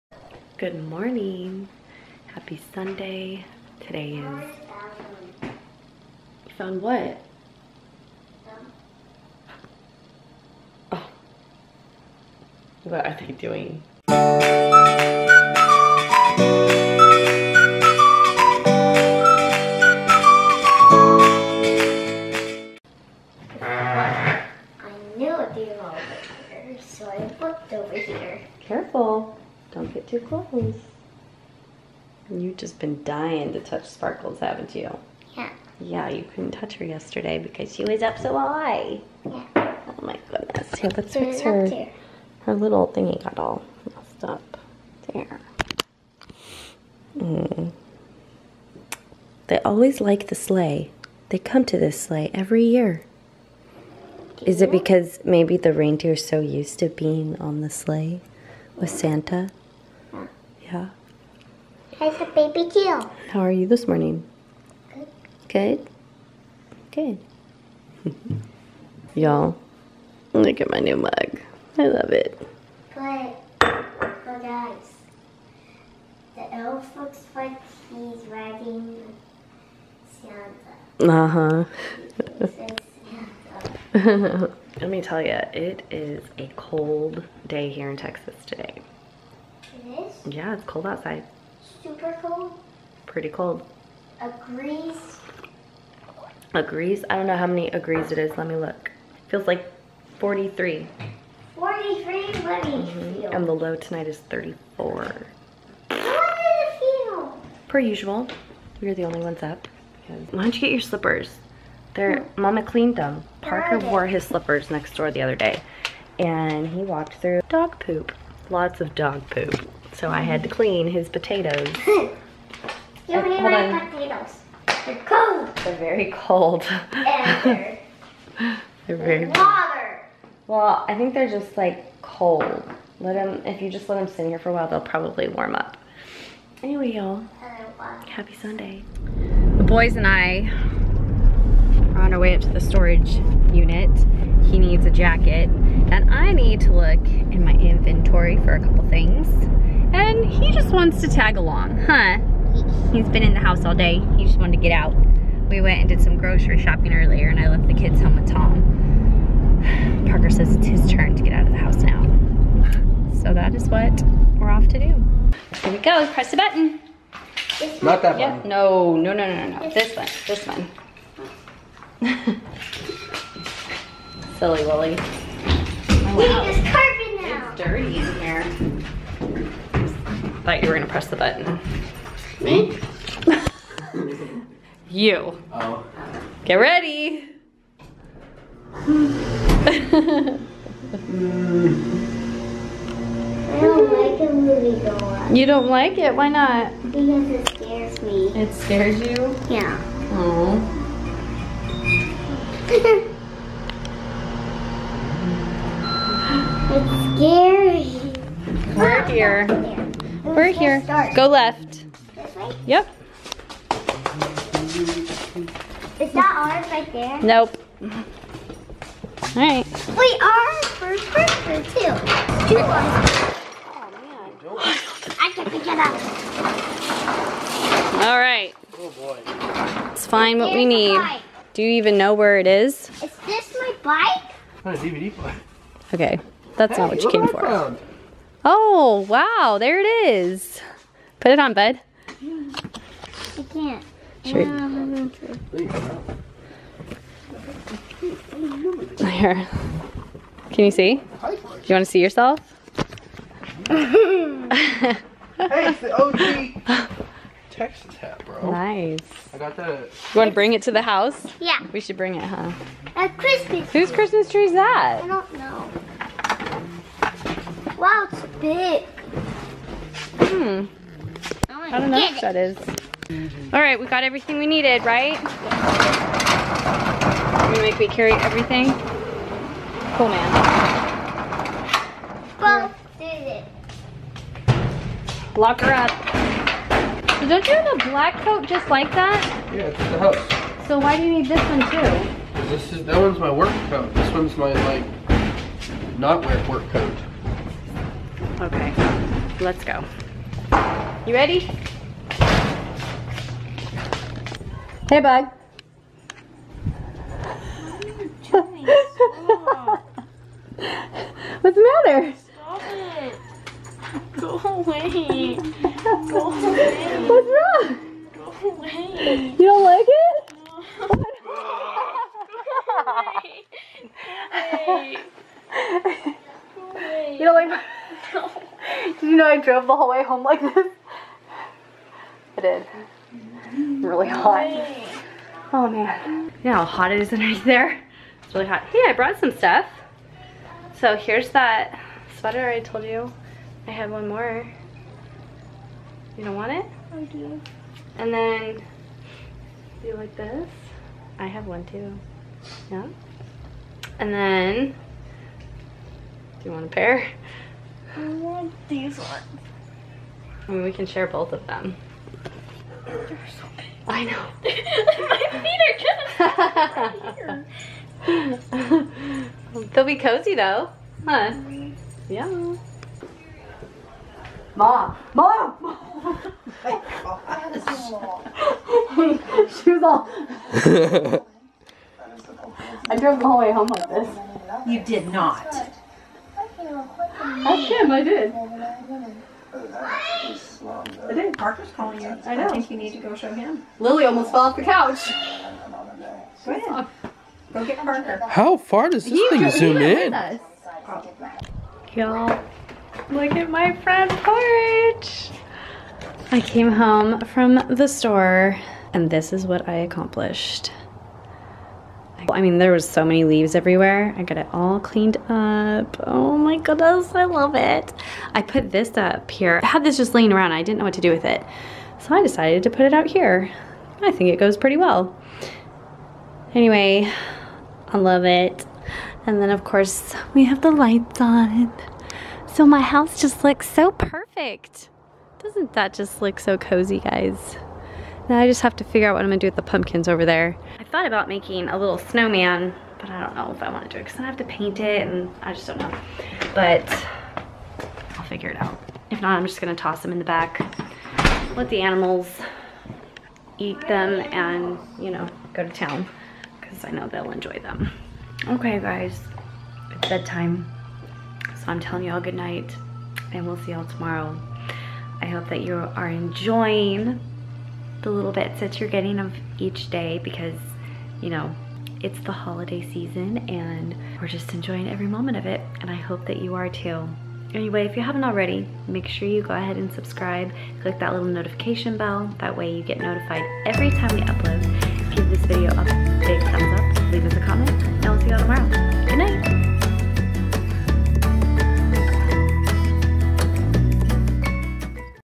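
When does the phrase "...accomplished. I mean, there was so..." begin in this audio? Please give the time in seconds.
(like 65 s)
409 s.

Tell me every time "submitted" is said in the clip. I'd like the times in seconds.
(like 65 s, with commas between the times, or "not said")
not said.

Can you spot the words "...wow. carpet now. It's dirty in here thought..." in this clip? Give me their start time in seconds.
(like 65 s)
176 s.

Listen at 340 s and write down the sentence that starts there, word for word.
So here's that sweater I told you.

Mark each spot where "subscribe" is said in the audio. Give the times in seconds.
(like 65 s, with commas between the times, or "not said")
479 s.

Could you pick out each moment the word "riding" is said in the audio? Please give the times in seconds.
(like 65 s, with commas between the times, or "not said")
78 s.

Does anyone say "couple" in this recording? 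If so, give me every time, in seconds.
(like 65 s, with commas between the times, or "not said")
148 s.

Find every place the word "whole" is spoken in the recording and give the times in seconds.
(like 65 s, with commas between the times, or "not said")
329 s, 383 s.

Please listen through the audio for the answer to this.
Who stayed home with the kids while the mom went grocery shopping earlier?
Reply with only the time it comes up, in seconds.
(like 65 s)
158 s.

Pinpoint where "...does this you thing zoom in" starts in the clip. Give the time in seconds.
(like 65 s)
398 s.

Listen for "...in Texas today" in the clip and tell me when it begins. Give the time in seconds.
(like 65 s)
87 s.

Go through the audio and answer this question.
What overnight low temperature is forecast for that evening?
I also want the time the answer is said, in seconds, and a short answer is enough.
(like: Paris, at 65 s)
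34, at 103 s.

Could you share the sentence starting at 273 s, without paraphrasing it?
All right, we got everything we needed, right?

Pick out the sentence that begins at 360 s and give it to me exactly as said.
I mean, we can share both of them.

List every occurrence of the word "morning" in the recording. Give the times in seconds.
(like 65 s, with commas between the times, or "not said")
0 s, 63 s.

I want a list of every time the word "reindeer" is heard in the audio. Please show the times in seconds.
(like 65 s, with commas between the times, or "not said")
55 s.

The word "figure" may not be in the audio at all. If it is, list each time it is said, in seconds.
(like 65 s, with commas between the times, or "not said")
438 s, 448 s.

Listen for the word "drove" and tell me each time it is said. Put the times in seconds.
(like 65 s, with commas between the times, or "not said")
329 s, 382 s.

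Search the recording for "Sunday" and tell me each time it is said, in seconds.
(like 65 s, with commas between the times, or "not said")
2 s, 138 s.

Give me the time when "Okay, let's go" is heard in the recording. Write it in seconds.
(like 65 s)
298 s.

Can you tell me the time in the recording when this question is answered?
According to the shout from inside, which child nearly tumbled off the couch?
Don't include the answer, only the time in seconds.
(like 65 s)
393 s.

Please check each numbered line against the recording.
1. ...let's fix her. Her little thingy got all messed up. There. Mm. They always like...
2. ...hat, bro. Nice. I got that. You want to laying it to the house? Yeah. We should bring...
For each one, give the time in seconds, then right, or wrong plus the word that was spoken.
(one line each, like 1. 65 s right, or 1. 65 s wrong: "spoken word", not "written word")
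1. 40 s right
2. 257 s wrong: "bring", not "laying".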